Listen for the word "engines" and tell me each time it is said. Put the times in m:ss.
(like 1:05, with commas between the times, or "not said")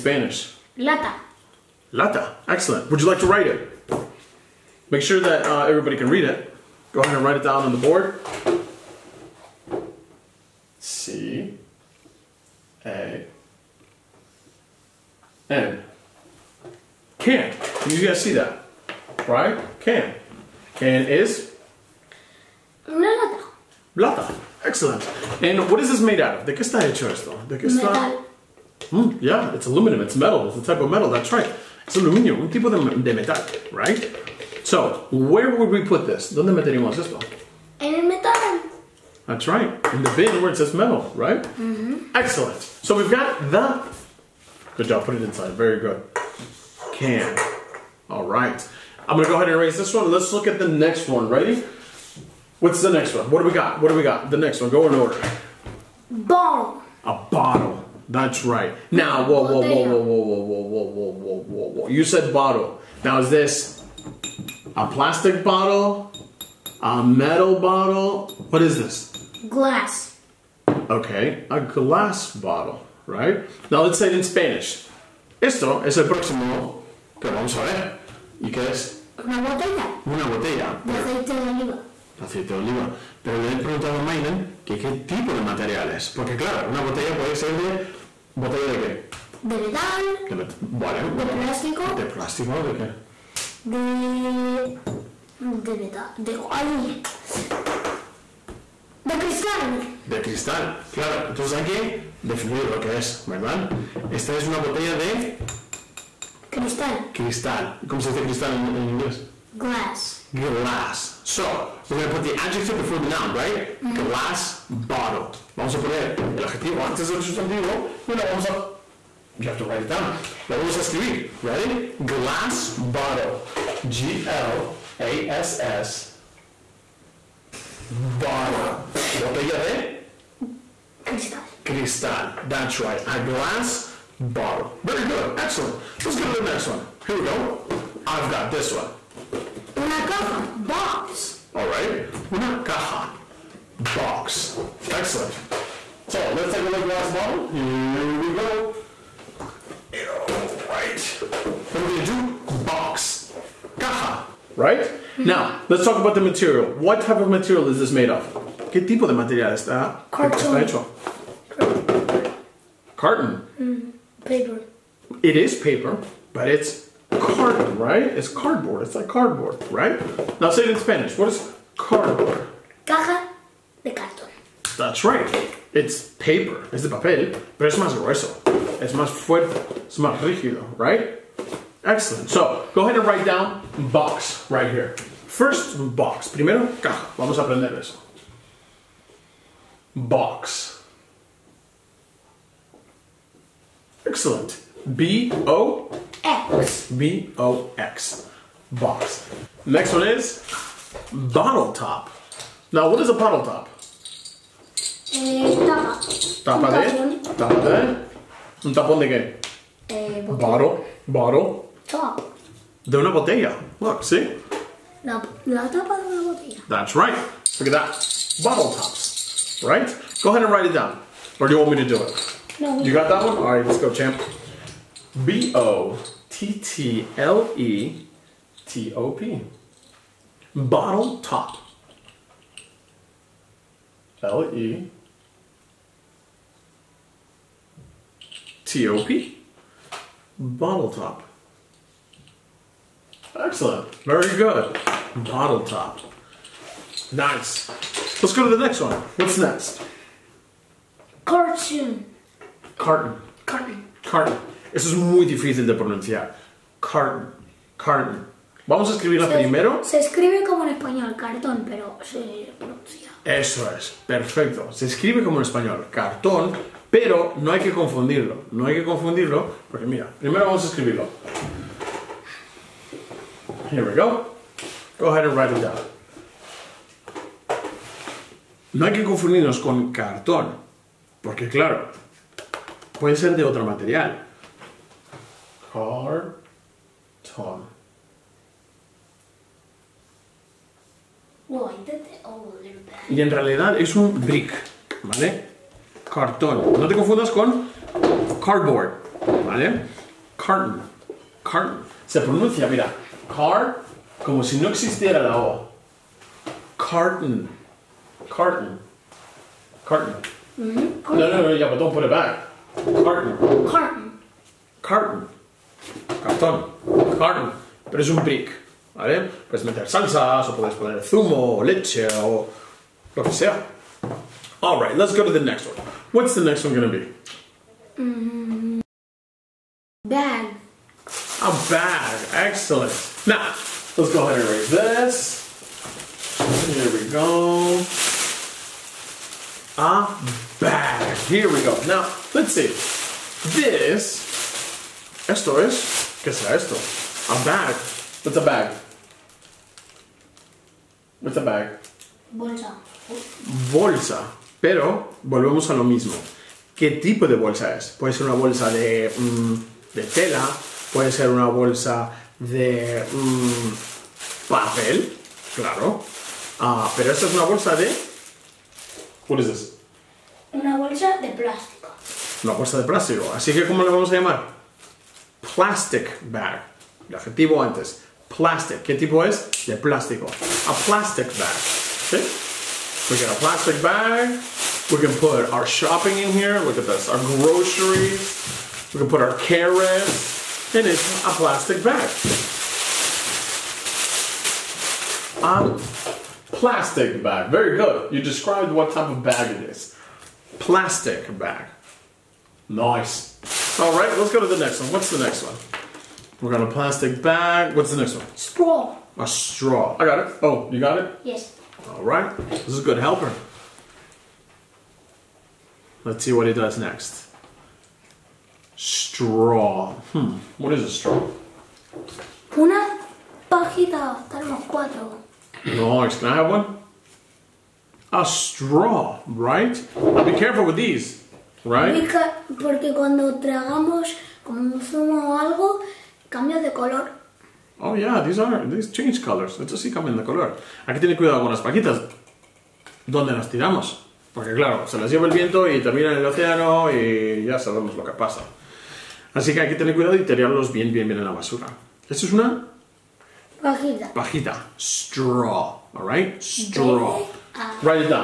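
not said.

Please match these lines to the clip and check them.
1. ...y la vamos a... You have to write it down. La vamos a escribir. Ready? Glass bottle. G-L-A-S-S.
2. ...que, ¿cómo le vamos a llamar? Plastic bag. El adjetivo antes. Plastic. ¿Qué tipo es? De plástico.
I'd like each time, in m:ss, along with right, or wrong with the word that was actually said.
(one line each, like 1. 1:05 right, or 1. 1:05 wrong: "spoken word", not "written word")
1. 1:58 right
2. 6:13 right.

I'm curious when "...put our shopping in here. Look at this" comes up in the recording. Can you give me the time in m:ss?
6:25.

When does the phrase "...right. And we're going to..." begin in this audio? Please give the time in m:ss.
2:30.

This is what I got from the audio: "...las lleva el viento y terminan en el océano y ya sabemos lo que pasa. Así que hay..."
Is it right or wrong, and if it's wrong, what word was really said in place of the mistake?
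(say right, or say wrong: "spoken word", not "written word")
right.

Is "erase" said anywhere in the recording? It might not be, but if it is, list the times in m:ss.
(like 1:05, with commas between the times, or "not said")
0:49, 5:34.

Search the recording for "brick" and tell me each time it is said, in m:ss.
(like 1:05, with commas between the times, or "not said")
4:54, 5:18.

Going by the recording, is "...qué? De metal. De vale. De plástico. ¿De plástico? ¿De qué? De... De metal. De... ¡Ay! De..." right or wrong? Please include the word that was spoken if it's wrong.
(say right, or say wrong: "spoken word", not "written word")
right.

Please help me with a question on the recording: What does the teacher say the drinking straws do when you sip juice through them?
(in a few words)
change colors.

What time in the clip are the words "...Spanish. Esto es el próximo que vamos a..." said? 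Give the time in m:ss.
1:14.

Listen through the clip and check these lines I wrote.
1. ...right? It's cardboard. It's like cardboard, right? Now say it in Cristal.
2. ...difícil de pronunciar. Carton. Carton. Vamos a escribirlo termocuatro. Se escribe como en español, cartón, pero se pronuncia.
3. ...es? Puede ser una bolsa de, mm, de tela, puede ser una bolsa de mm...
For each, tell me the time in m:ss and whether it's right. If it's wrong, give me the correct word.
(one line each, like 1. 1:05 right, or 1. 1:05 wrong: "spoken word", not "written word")
1. 2:47 wrong: "Spanish", not "Cristal"
2. 4:15 wrong: "primero", not "termocuatro"
3. 5:57 right.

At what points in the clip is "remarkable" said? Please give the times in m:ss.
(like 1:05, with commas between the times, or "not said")
not said.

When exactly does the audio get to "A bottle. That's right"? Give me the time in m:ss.
0:57.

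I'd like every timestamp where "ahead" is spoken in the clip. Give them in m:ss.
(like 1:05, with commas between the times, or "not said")
0:07, 0:49, 3:02, 3:40, 4:35, 5:34.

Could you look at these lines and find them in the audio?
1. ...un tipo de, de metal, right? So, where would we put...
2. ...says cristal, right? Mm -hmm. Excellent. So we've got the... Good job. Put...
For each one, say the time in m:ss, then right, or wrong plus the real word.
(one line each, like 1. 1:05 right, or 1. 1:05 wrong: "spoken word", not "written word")
1. 0:32 right
2. 0:40 wrong: "metal", not "cristal".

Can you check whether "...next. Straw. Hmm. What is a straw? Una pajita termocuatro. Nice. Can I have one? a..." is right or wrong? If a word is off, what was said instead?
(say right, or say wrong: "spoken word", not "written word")
right.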